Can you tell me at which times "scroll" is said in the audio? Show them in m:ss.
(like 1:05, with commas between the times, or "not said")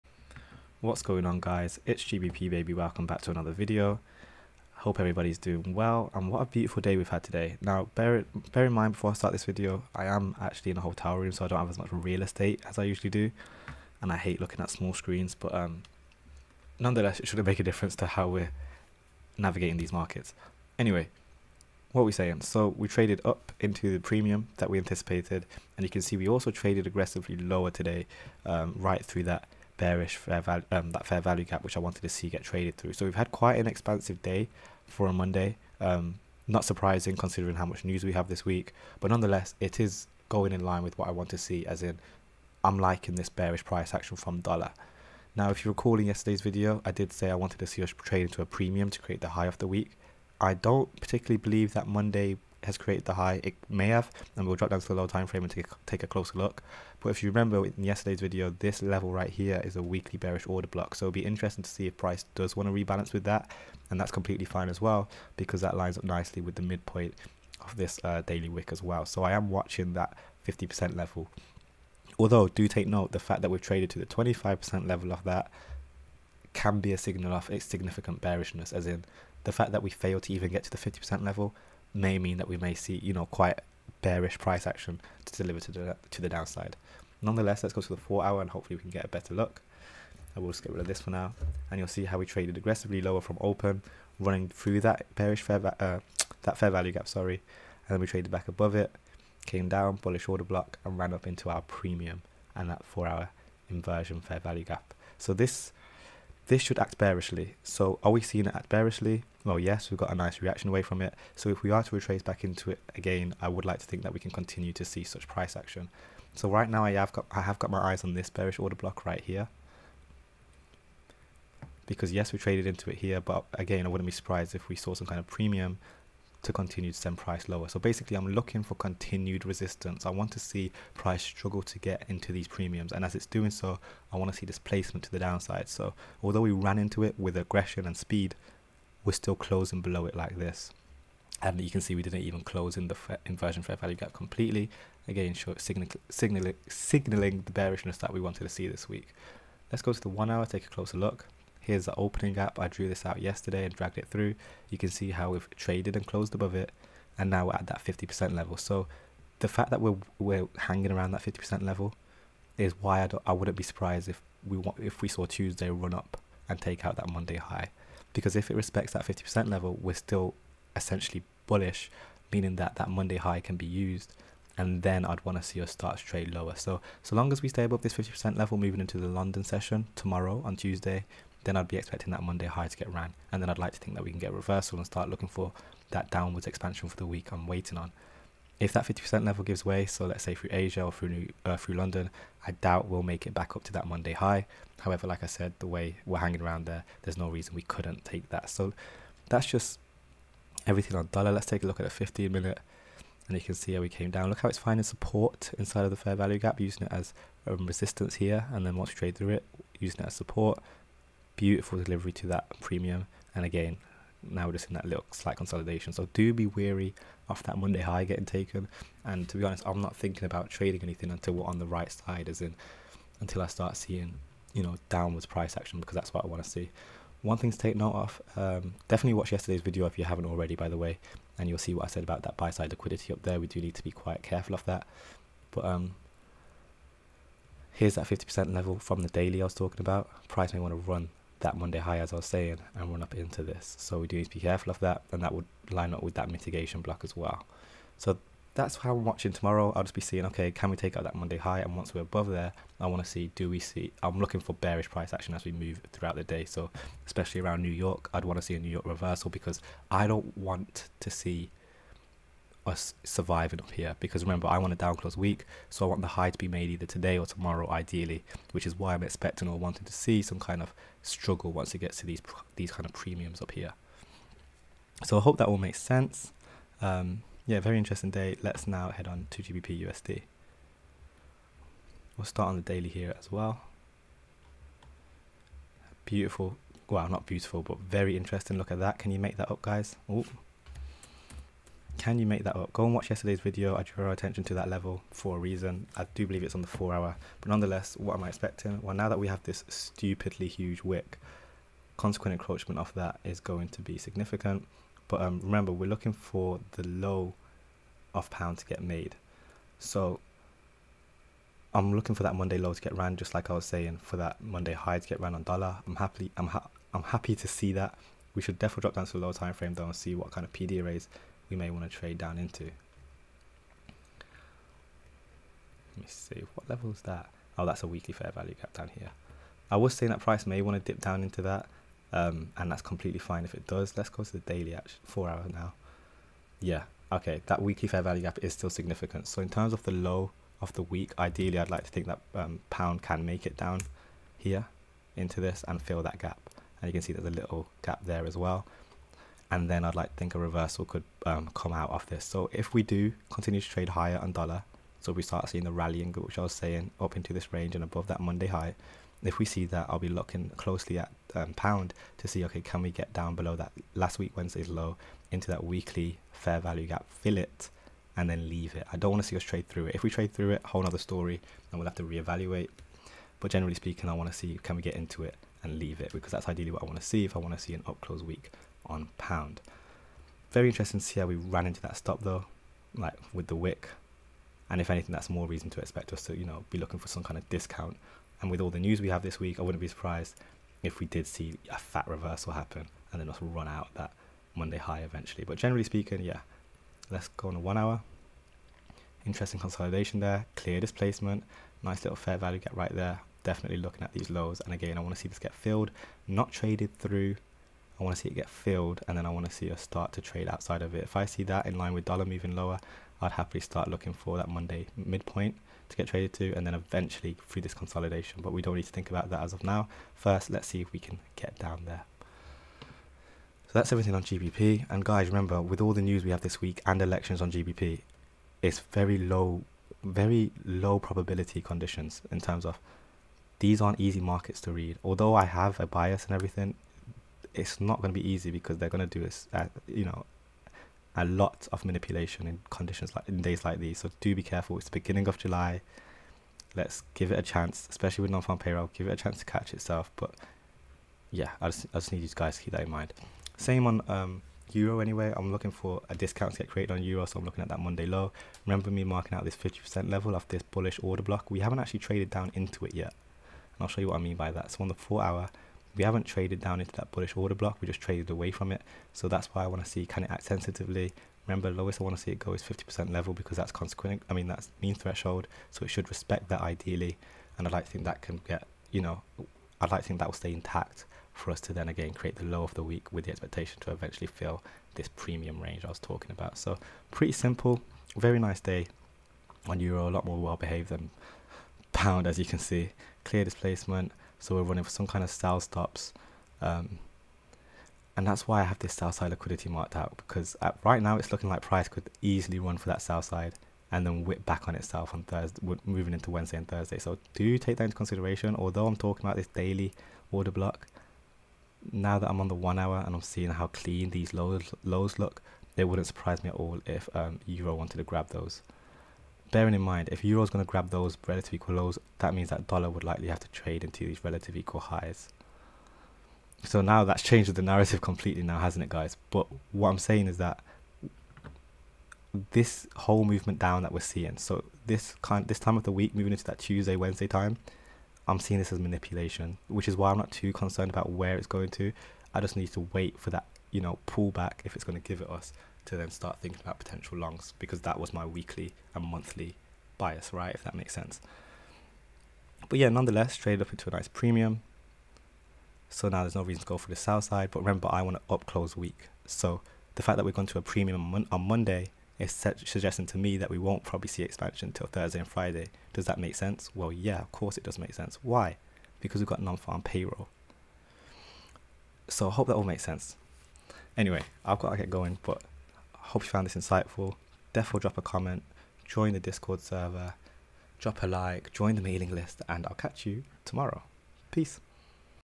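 not said.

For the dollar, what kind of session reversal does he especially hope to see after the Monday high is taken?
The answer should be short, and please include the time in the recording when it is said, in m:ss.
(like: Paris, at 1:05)
New York reversal, at 4:18.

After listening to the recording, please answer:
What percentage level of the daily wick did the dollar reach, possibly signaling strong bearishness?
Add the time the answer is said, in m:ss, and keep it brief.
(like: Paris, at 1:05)
25%, at 1:14.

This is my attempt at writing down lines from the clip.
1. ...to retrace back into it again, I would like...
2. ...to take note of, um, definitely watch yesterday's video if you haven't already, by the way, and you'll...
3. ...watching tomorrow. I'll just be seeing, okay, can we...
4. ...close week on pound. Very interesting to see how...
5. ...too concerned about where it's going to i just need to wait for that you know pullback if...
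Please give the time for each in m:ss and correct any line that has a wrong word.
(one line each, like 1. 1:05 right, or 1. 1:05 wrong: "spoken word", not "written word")
1. 1:51 right
2. 3:47 right
3. 4:09 right
4. 6:18 right
5. 9:00 right.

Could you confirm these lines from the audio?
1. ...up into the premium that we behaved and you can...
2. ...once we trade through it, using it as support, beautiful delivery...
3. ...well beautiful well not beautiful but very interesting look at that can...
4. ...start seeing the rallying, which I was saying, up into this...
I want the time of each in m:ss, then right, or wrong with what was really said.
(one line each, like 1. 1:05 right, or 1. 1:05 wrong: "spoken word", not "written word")
1. 0:23 wrong: "anticipated", not "behaved"
2. 3:28 right
3. 4:43 right
4. 5:55 right.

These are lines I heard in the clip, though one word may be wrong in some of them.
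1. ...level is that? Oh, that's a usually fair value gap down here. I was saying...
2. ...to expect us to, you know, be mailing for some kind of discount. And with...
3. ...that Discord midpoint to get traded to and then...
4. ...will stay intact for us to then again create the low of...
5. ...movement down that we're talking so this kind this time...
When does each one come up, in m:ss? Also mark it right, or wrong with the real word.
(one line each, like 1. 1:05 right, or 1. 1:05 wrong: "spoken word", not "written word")
1. 5:26 wrong: "weekly", not "usually"
2. 6:25 wrong: "looking", not "mailing"
3. 6:54 wrong: "Monday", not "Discord"
4. 8:00 right
5. 8:53 wrong: "seeing", not "talking".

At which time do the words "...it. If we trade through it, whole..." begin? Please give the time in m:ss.
6:09.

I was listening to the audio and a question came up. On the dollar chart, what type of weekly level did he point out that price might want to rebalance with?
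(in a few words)
Weekly bearish order block.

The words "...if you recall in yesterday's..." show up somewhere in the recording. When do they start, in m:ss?
0:45.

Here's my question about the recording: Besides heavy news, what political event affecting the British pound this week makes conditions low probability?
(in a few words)
Elections.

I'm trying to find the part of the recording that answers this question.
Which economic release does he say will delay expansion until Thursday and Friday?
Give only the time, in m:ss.
9:29.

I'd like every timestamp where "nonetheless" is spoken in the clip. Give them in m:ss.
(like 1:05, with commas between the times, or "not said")
0:16, 0:39, 1:27, 4:57, 9:12.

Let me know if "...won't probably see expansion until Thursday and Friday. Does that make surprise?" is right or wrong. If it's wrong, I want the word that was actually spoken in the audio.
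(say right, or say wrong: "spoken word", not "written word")
wrong: "sense", not "surprise".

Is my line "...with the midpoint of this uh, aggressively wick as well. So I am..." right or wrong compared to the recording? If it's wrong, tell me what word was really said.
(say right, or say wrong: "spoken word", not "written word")
wrong: "daily", not "aggressively".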